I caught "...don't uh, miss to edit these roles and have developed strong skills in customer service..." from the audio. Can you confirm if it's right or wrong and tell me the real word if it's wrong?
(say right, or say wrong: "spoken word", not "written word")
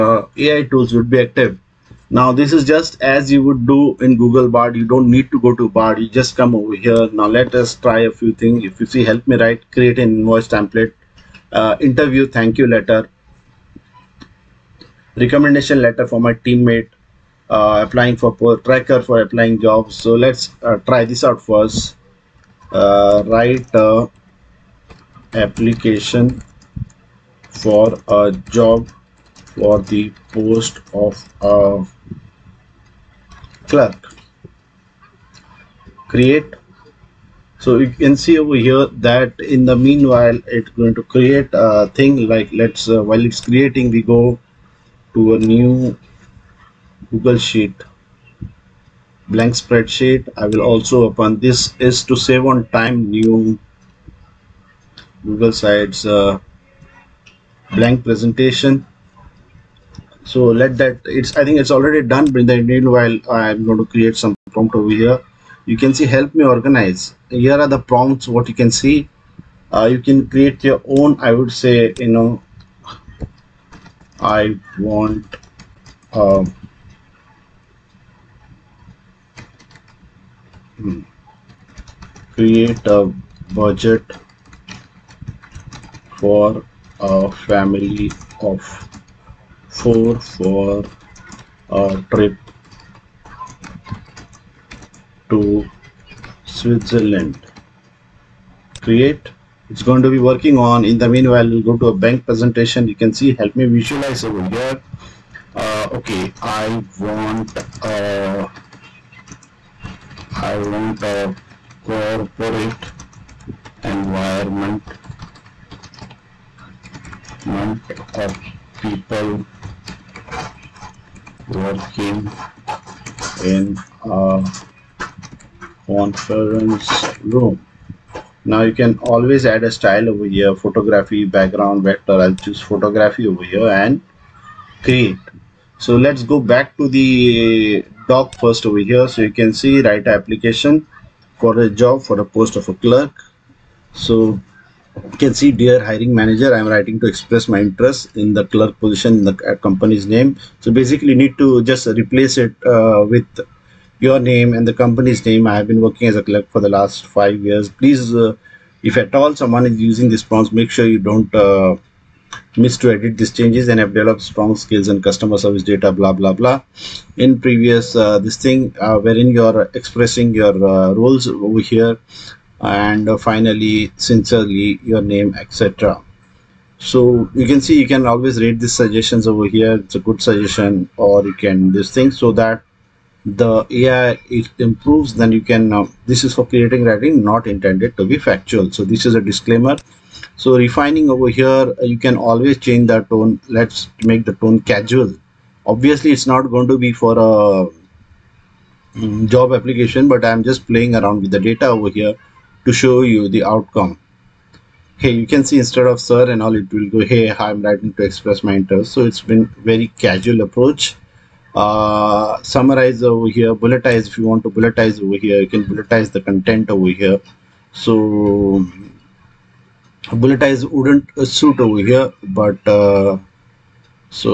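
wrong: "changes", not "roles".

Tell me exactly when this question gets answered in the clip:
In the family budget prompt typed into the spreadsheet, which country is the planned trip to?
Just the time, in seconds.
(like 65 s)
96 s.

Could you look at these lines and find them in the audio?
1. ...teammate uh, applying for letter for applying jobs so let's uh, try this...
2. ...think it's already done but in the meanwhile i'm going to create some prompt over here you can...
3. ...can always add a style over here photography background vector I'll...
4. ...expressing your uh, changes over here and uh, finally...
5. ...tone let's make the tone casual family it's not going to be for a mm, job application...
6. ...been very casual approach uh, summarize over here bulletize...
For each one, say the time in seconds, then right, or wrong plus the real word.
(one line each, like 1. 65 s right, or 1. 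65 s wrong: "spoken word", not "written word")
1. 16 s wrong: "tracker", not "letter"
2. 61 s right
3. 128 s right
4. 169 s wrong: "roles", not "changes"
5. 193 s wrong: "obviously", not "family"
6. 209 s right.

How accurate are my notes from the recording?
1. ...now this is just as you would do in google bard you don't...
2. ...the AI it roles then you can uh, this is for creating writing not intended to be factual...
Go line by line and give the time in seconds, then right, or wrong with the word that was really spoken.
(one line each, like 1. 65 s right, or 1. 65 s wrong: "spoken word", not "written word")
1. 2 s right
2. 183 s wrong: "improves", not "roles".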